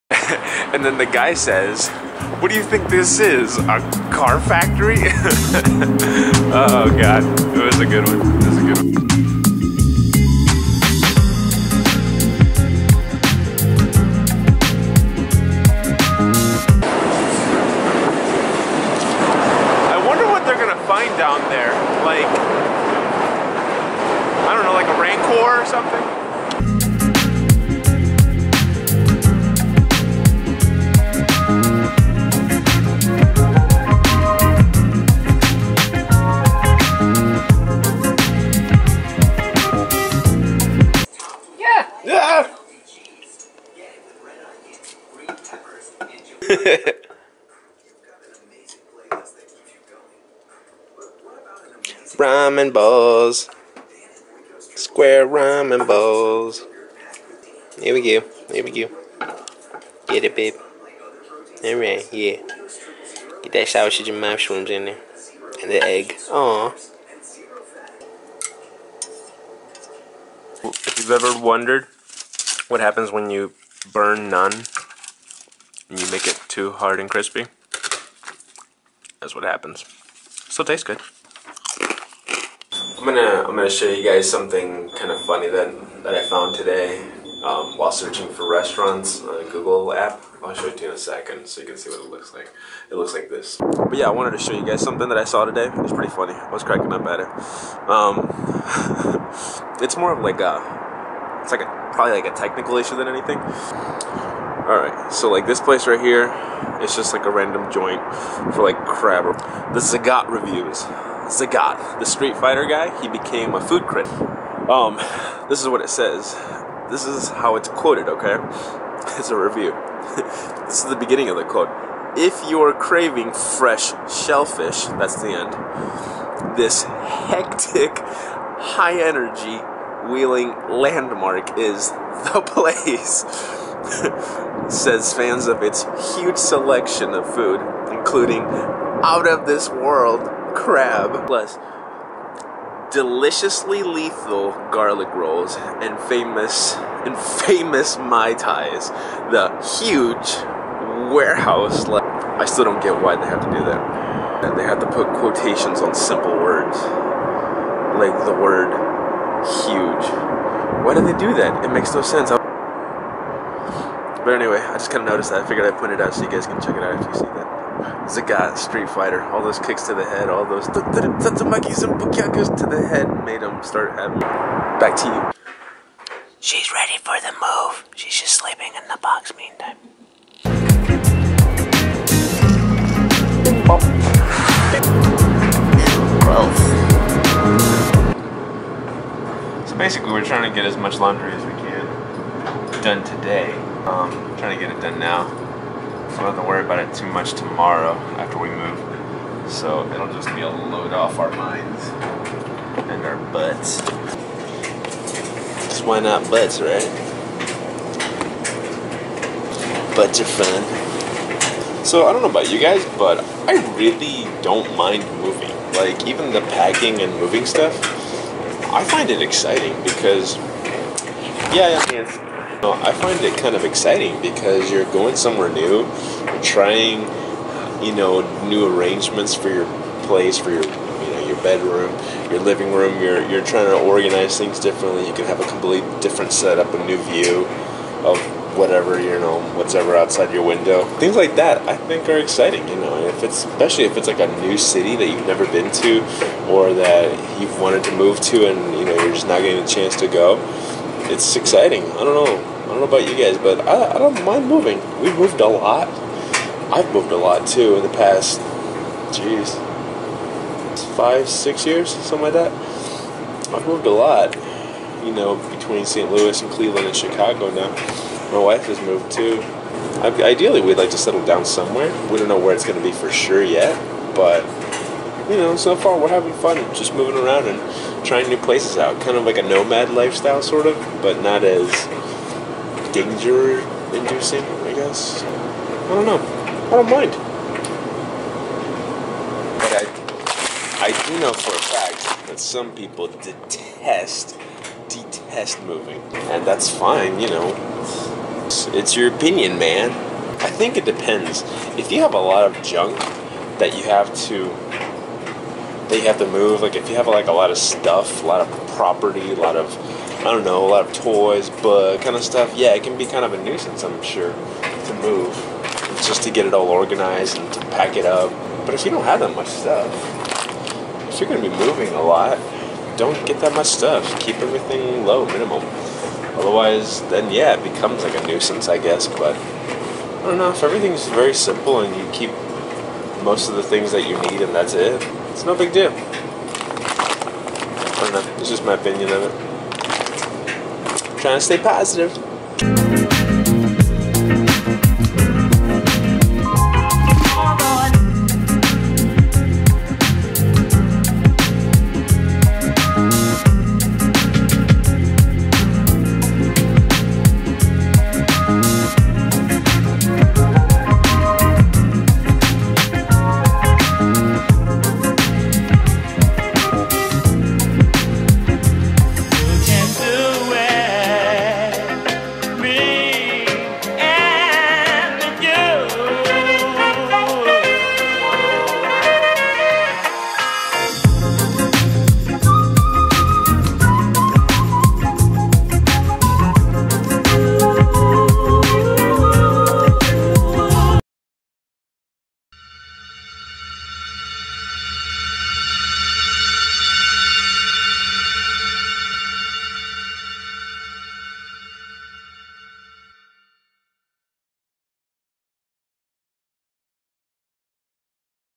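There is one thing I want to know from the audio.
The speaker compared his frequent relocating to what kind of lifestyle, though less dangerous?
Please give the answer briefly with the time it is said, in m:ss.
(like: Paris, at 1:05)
nomad lifestyle, at 4:39.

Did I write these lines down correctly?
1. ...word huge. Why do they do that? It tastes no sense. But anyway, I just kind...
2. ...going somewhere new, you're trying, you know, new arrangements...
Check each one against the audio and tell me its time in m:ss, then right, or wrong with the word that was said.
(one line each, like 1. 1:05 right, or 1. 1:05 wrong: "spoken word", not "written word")
1. 2:38 wrong: "makes", not "tastes"
2. 3:44 right.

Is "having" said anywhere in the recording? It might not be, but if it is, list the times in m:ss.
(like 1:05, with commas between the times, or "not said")
2:53, 4:36.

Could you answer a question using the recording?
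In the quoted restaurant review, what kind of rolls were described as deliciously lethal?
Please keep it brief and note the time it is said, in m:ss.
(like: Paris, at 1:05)
garlic rolls, at 2:24.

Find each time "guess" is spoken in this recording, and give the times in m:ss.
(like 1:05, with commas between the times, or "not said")
4:44, 5:28.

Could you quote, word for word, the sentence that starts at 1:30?
I'll show it to you in a second so you can see what it looks like.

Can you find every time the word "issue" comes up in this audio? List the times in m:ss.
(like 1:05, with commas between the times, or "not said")
1:42.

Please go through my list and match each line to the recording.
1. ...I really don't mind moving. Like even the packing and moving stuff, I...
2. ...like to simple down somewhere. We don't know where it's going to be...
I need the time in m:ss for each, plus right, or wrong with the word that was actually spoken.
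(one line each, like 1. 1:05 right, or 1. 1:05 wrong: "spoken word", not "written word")
1. 3:33 right
2. 4:30 wrong: "settle", not "simple".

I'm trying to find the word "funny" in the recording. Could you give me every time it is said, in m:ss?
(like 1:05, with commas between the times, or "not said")
1:25, 1:36.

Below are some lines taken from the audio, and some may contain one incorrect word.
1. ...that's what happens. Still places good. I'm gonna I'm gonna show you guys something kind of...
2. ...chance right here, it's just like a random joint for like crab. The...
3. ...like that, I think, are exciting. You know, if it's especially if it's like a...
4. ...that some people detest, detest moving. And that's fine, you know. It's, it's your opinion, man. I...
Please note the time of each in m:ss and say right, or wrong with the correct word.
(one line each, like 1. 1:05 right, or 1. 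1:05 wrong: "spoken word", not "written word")
1. 1:19 wrong: "tastes", not "places"
2. 1:45 wrong: "place", not "chance"
3. 4:01 right
4. 4:52 right.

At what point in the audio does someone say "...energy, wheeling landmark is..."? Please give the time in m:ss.
2:09.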